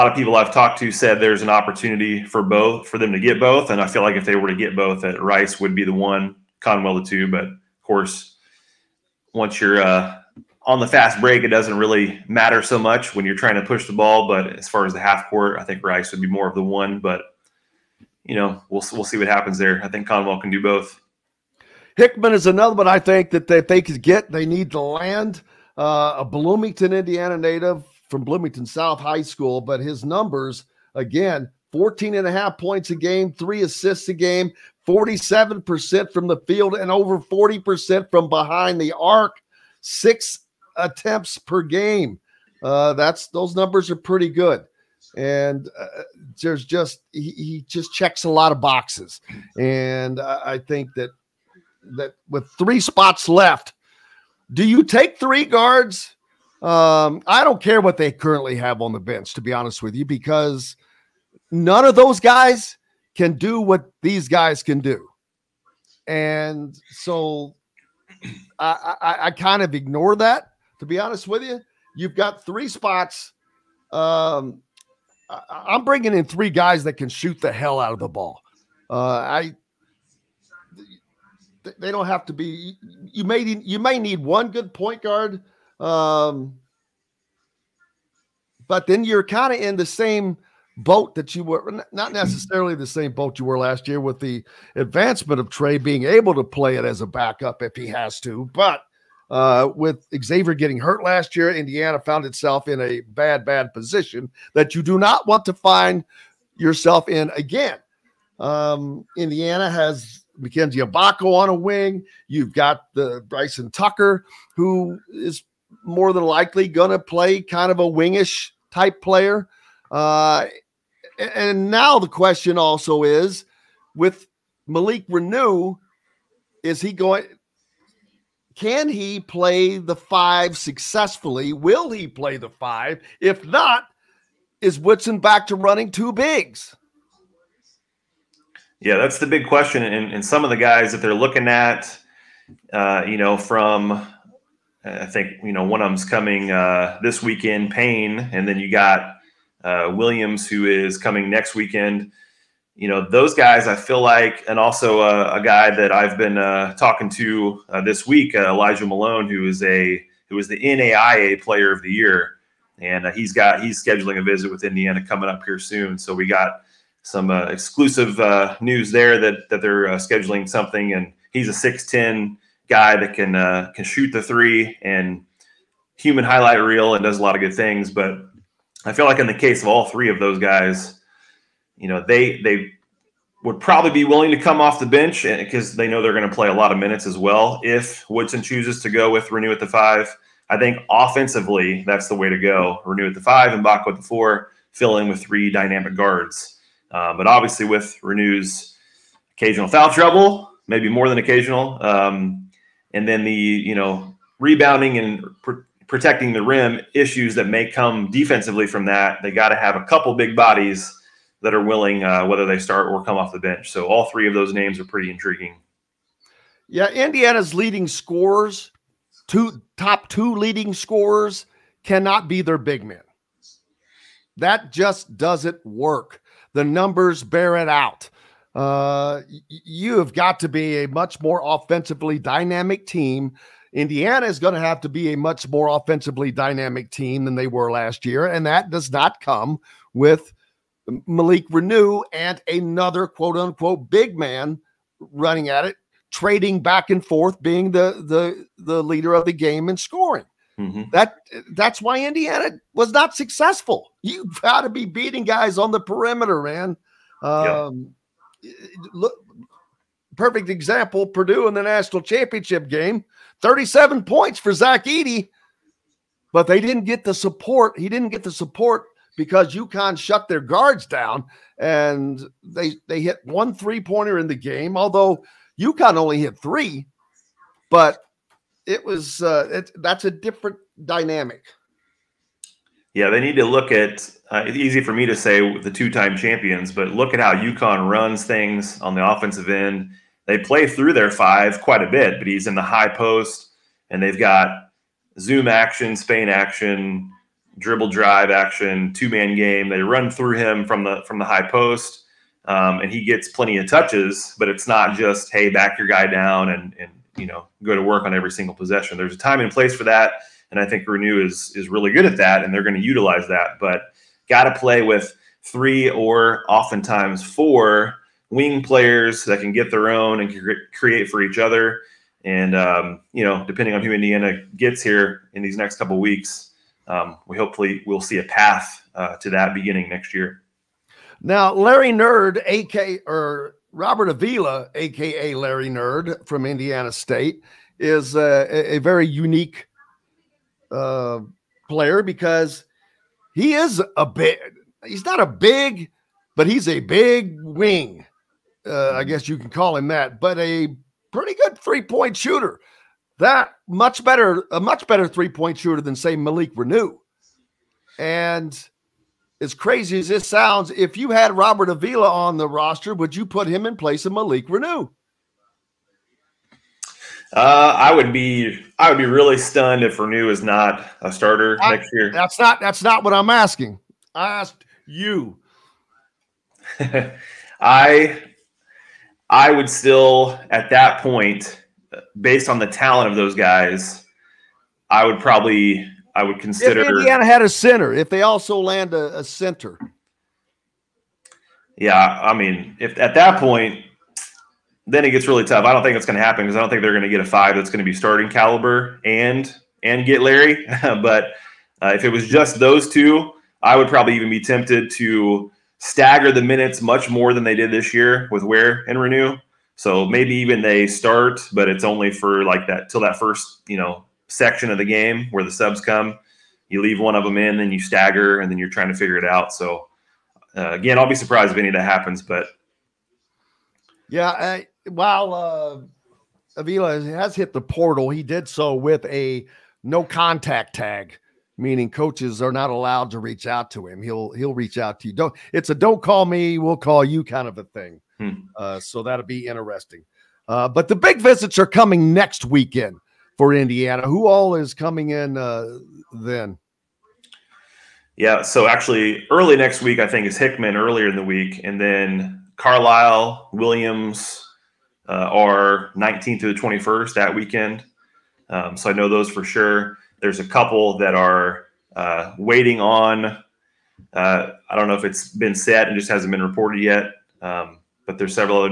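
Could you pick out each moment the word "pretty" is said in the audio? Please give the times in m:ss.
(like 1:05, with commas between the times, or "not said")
0:43, 3:34, 5:51.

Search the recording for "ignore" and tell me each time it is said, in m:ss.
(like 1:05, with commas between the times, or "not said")
1:09.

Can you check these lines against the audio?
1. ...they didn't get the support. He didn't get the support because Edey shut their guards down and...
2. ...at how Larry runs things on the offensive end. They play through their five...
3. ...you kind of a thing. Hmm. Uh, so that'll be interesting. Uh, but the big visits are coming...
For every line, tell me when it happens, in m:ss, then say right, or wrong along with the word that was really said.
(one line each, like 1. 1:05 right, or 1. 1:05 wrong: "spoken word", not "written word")
1. 4:26 wrong: "UConn", not "Edey"
2. 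4:47 wrong: "UConn", not "Larry"
3. 7:17 right.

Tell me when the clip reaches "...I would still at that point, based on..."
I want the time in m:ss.
6:19.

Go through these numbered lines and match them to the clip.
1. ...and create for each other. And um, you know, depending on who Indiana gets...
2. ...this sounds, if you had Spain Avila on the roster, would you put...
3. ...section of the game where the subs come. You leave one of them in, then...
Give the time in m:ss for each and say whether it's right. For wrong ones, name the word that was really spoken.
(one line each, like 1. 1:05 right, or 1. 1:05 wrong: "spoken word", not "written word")
1. 5:20 right
2. 6:00 wrong: "Robert", not "Spain"
3. 6:54 right.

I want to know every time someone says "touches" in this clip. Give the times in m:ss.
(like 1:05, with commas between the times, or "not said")
5:03.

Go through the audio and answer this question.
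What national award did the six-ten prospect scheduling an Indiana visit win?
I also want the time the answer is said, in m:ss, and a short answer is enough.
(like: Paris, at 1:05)
NAIA Player of the Year, at 2:40.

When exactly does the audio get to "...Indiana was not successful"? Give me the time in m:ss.
4:12.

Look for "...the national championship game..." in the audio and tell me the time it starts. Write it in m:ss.
4:21.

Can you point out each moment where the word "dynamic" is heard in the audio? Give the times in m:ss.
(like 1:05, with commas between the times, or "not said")
3:15, 3:52, 3:56, 4:40.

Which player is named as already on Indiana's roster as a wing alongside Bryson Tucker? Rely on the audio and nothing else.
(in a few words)
Mackenzie Abako.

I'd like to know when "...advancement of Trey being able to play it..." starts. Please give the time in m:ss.
1:34.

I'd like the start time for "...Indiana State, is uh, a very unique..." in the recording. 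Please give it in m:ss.
5:36.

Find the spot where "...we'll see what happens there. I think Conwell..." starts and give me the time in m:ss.
0:18.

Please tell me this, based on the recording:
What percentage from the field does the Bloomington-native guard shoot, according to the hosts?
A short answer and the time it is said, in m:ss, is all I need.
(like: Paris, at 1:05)
47%, at 0:34.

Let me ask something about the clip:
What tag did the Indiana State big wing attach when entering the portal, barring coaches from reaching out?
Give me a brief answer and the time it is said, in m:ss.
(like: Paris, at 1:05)
No contact tag, at 7:09.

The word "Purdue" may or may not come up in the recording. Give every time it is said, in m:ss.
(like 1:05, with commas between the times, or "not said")
4:21.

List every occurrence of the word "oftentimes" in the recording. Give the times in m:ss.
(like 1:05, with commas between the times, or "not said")
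5:16.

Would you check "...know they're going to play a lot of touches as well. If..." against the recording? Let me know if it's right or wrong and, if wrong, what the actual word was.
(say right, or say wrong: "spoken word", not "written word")
wrong: "minutes", not "touches".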